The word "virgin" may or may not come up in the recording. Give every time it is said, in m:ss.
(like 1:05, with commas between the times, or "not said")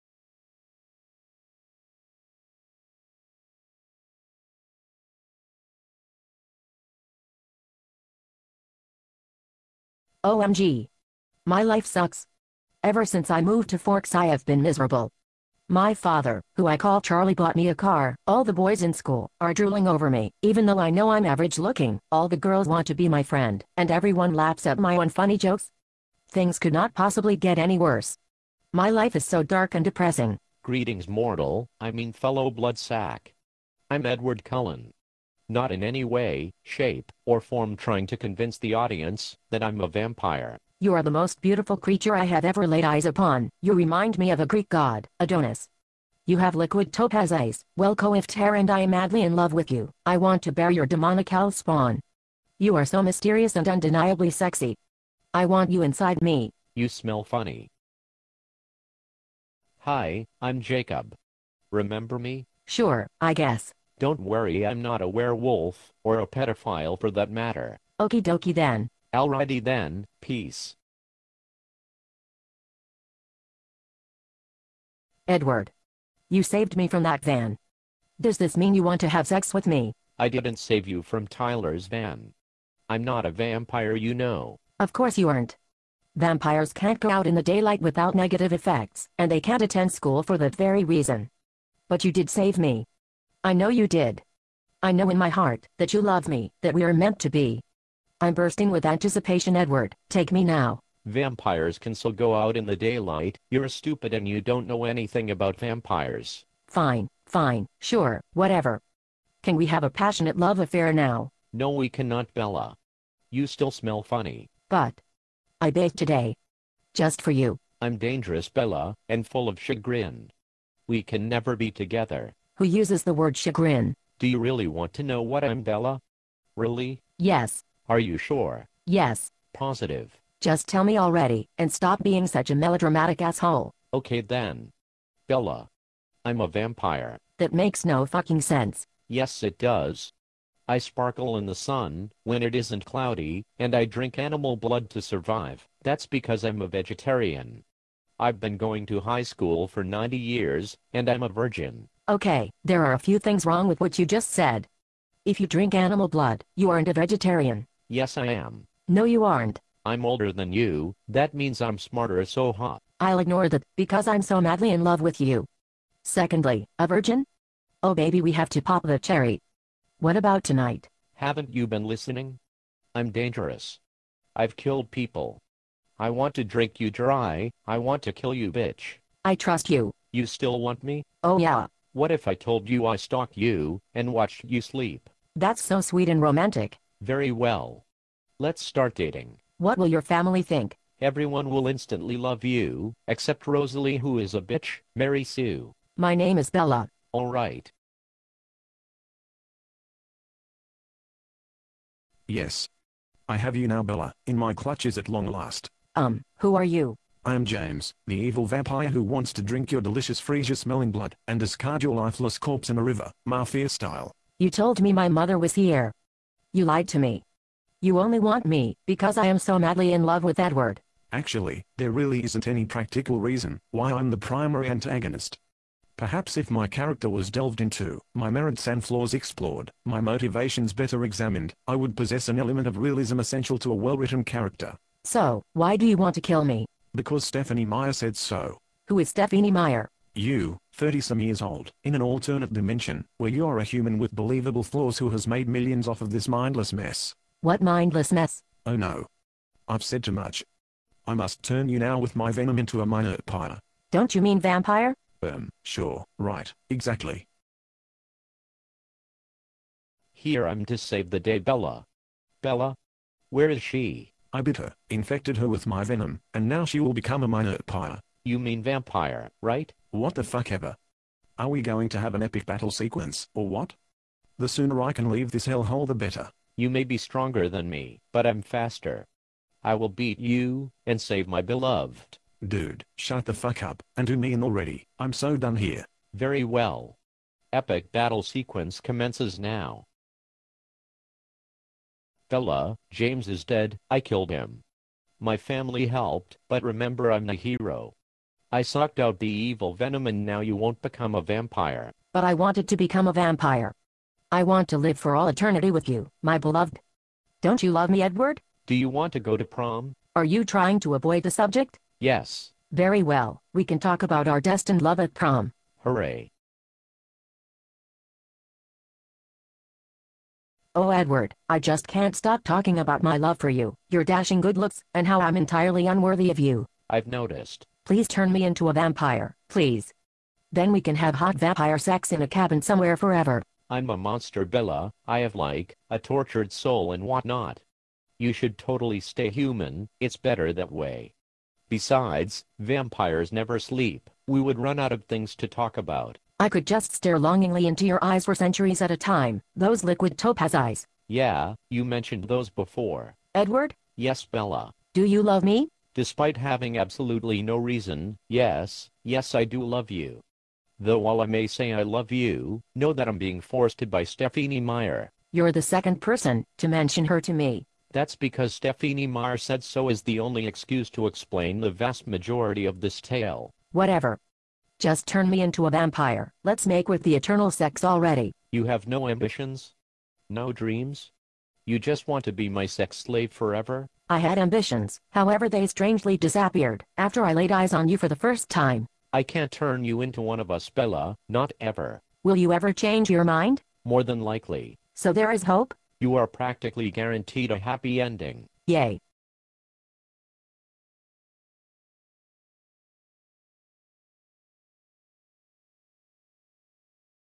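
2:31, 2:46.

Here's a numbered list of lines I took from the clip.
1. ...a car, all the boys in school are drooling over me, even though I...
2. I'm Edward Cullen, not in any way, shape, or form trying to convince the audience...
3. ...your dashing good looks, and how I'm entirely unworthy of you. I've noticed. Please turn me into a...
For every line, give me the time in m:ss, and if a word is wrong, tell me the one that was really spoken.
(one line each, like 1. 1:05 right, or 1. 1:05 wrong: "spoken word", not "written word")
1. 0:17 right
2. 0:33 right
3. 5:23 right.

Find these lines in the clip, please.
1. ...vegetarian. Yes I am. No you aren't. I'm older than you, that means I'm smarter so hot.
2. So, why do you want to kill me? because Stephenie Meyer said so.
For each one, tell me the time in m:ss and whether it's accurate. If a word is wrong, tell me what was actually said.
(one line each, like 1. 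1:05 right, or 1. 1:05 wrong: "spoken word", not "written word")
1. 2:36 right
2. 3:55 right.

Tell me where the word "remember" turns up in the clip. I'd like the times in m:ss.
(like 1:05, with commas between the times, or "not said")
1:01, 4:56.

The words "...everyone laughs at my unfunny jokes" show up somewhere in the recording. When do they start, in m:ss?
0:23.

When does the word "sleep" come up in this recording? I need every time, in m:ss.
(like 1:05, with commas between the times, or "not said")
3:04, 5:43.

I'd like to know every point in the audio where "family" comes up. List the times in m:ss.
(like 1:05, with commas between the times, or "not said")
3:10, 4:55.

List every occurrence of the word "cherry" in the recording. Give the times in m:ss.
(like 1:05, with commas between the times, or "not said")
2:48.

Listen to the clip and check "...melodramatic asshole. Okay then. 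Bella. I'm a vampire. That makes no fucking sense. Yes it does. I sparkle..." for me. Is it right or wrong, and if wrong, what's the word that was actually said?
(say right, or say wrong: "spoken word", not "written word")
right.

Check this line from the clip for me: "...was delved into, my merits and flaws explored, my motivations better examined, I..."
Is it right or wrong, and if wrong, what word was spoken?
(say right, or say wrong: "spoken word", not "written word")
right.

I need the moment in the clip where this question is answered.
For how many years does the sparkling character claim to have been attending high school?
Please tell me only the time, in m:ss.
2:29.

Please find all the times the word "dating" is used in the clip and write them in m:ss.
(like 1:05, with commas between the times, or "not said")
3:08.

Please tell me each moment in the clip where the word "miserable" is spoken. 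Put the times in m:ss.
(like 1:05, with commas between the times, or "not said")
0:14.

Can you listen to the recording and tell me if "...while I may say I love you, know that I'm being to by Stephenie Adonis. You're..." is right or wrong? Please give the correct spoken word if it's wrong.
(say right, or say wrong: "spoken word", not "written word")
wrong: "Meyer", not "Adonis".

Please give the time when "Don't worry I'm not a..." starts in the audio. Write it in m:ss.
1:04.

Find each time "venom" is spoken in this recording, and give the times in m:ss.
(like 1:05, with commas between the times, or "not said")
4:12, 4:25, 4:59.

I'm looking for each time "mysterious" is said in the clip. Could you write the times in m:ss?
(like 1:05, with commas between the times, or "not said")
0:53.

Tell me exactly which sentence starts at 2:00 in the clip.
We can never be together who uses the word chagrin.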